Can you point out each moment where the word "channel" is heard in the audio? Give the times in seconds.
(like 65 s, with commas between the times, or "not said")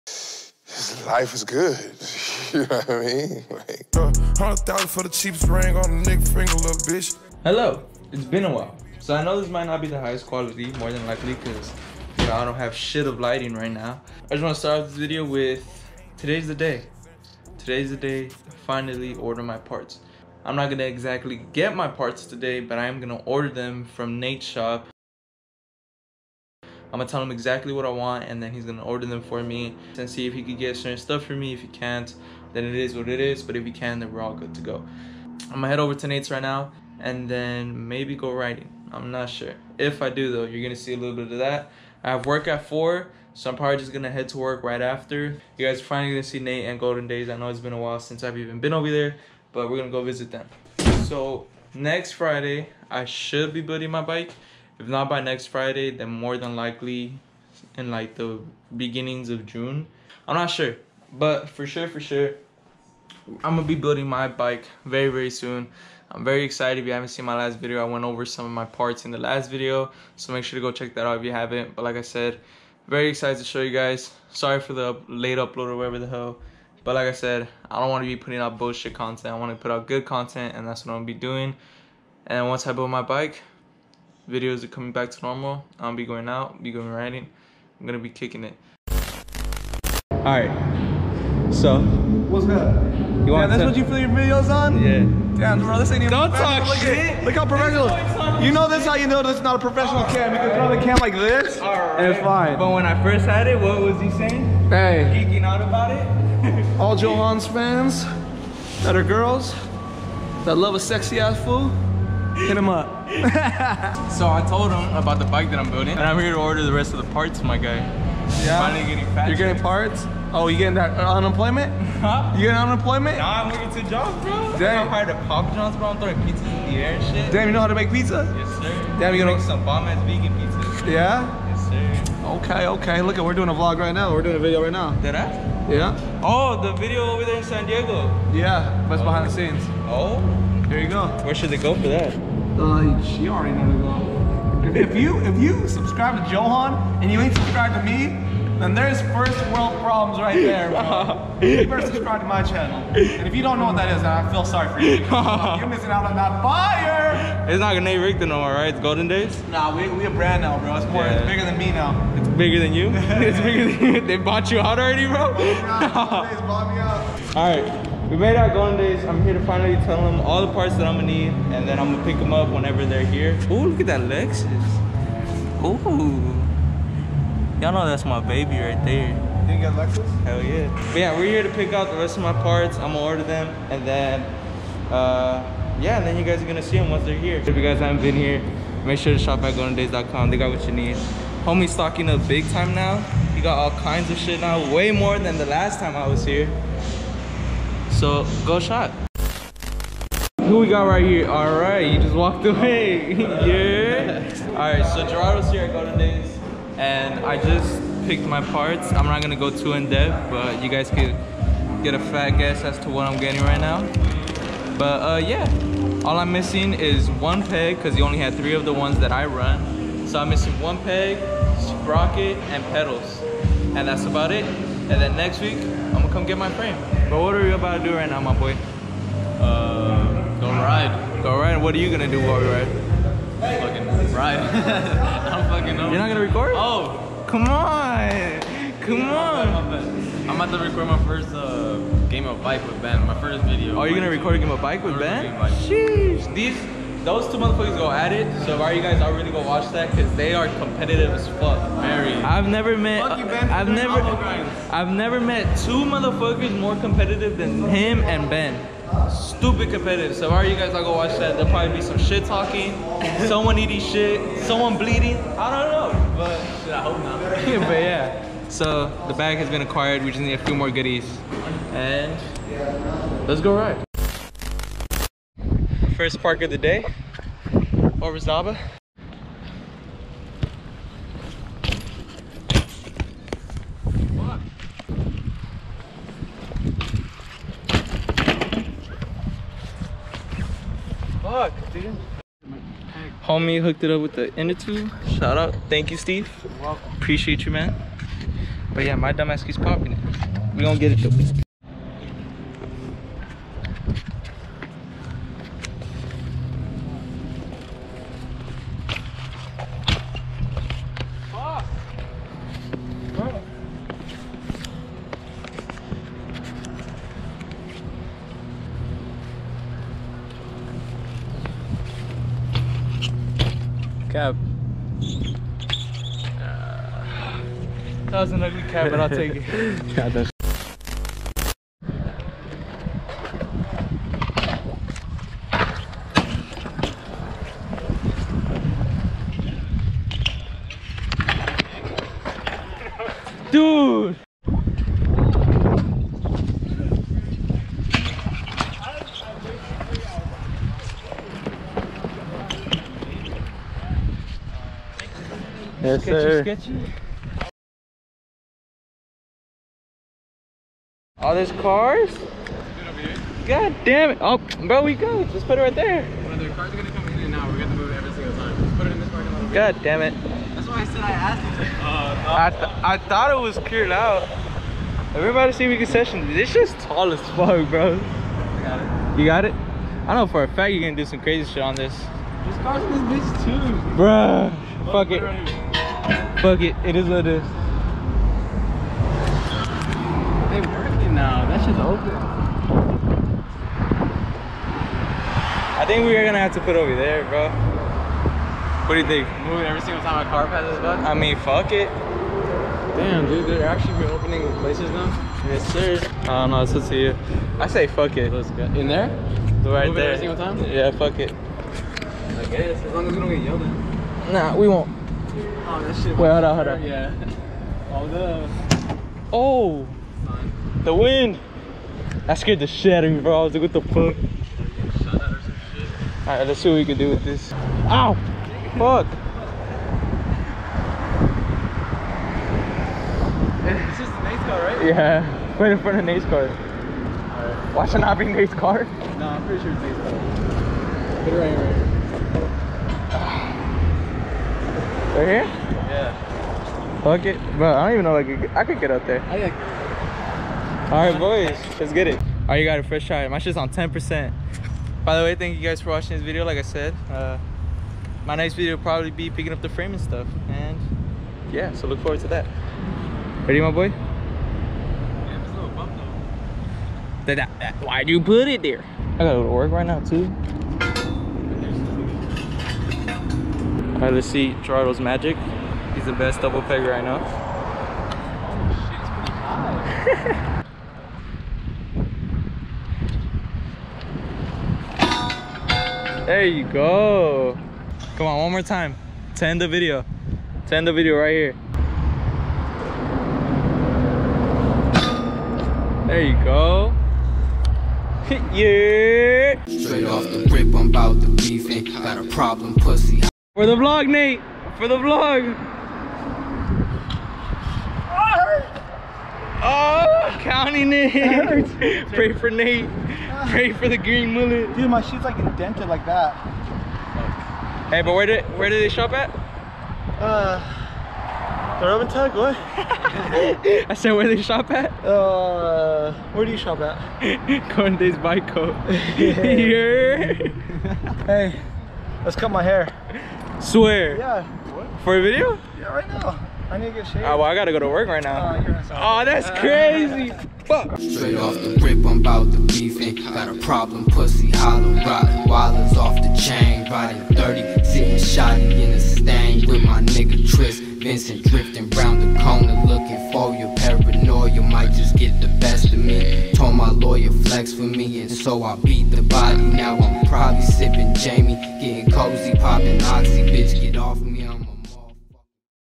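152 s.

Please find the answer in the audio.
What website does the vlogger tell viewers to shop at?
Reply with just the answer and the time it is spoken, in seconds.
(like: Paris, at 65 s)
goldendays.com, at 189 s.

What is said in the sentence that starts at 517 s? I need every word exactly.
Hey, but where did where did they shop at?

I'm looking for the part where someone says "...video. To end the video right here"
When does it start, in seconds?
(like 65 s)
489 s.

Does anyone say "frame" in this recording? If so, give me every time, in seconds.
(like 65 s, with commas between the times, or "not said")
226 s, 459 s.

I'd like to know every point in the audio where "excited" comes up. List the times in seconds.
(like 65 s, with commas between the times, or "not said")
66 s, 73 s.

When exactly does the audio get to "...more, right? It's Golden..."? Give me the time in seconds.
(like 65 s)
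158 s.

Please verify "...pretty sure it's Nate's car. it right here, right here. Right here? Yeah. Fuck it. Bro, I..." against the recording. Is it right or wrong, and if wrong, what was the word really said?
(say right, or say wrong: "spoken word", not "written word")
right.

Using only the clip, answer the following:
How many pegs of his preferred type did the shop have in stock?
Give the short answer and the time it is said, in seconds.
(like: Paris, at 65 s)
3, at 218 s.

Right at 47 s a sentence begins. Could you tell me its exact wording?
I know it's been a while since I've even been over there, but we're gonna go visit them.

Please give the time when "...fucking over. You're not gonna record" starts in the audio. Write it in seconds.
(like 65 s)
235 s.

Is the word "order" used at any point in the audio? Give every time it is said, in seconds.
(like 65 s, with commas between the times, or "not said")
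19 s, 23 s, 28 s, 116 s, 182 s.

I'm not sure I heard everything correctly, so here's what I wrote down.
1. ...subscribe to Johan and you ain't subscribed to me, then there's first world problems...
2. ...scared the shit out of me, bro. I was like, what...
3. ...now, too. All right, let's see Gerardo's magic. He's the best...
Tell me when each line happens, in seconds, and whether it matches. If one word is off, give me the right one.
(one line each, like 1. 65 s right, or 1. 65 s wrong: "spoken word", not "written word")
1. 145 s right
2. 422 s right
3. 469 s right.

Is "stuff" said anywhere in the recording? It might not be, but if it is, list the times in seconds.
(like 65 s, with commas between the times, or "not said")
30 s, 460 s.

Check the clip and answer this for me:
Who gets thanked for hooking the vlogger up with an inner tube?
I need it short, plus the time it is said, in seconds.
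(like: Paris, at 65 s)
Steve, at 295 s.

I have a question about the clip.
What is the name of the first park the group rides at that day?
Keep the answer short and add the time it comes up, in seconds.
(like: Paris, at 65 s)
Orizaba, at 278 s.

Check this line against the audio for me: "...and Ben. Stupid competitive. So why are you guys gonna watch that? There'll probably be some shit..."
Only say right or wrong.
right.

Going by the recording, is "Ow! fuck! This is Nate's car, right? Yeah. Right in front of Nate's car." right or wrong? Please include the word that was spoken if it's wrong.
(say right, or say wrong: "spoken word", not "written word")
right.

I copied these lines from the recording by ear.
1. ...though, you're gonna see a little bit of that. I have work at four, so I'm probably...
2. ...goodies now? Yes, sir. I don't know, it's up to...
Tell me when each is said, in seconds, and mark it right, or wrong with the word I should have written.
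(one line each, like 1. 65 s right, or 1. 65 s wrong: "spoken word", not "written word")
1. 40 s right
2. 404 s wrong: "places", not "goodies".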